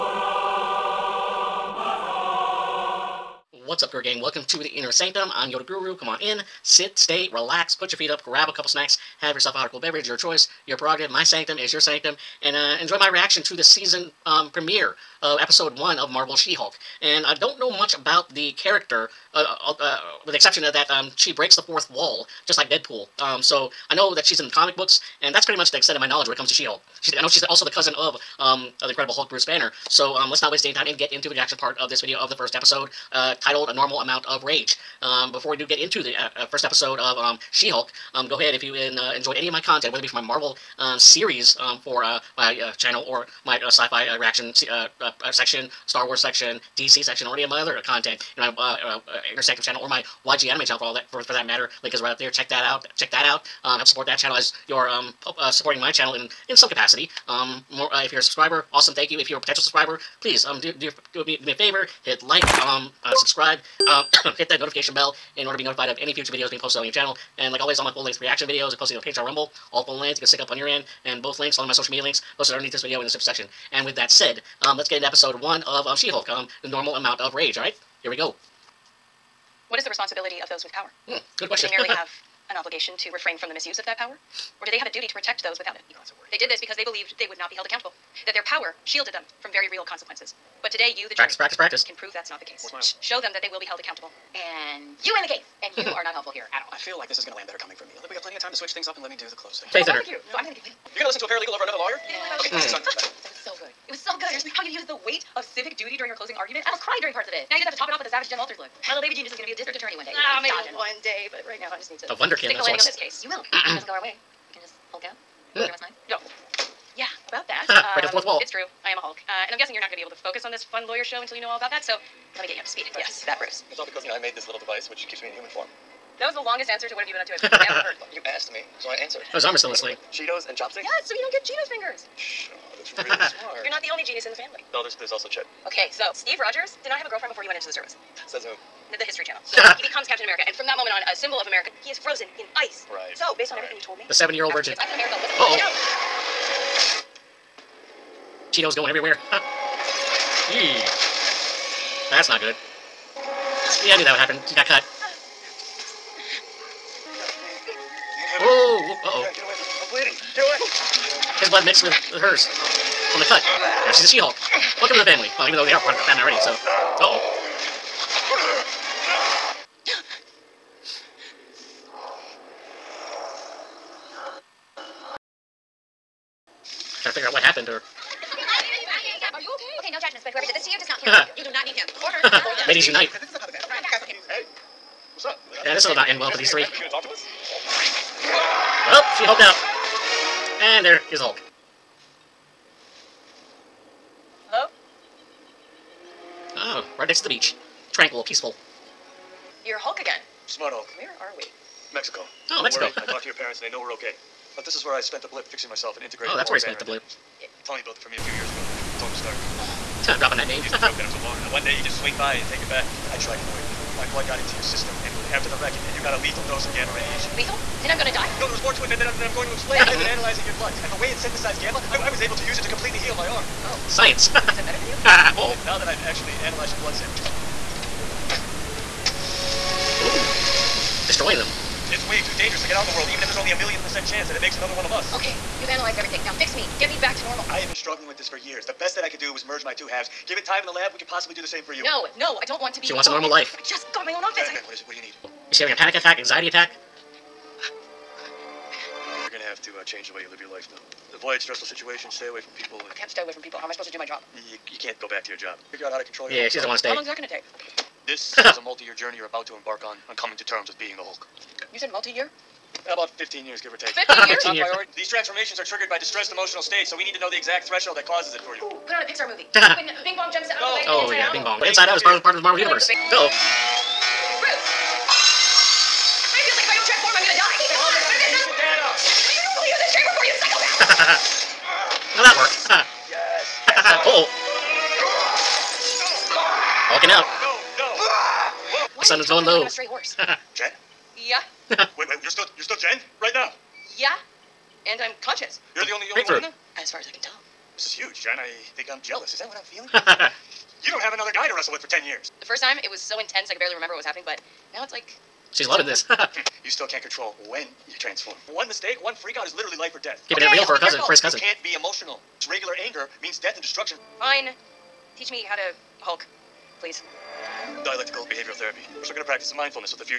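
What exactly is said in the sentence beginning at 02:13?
You're not the only genius in the family.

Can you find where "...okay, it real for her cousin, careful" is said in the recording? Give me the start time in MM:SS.
05:10.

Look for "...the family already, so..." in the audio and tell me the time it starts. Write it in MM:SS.
02:45.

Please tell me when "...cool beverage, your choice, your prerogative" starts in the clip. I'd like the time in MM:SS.
00:09.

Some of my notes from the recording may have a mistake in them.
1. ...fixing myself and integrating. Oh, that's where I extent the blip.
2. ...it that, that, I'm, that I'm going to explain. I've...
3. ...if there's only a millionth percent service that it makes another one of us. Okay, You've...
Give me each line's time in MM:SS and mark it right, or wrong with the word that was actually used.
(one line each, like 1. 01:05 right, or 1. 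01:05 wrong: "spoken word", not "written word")
1. 03:25 wrong: "spent", not "extent"
2. 03:38 right
3. 03:53 wrong: "chance", not "service".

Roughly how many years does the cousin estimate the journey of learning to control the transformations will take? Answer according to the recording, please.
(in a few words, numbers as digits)
15.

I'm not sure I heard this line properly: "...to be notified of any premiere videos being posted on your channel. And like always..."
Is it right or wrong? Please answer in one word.
wrong.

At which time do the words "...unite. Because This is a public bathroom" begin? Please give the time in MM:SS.
03:02.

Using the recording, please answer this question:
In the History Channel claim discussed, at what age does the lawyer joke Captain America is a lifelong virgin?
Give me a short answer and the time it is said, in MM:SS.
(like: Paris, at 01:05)
70, at 02:24.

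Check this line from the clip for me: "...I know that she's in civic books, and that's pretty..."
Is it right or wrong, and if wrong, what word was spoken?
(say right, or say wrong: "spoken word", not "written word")
wrong: "comic", not "civic".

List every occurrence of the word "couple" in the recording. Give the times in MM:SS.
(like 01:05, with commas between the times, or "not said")
00:08.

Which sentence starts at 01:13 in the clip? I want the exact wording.
And with that said, um, let's get into episode one of um, She-Hulk, um, the normal amount of rage, alright?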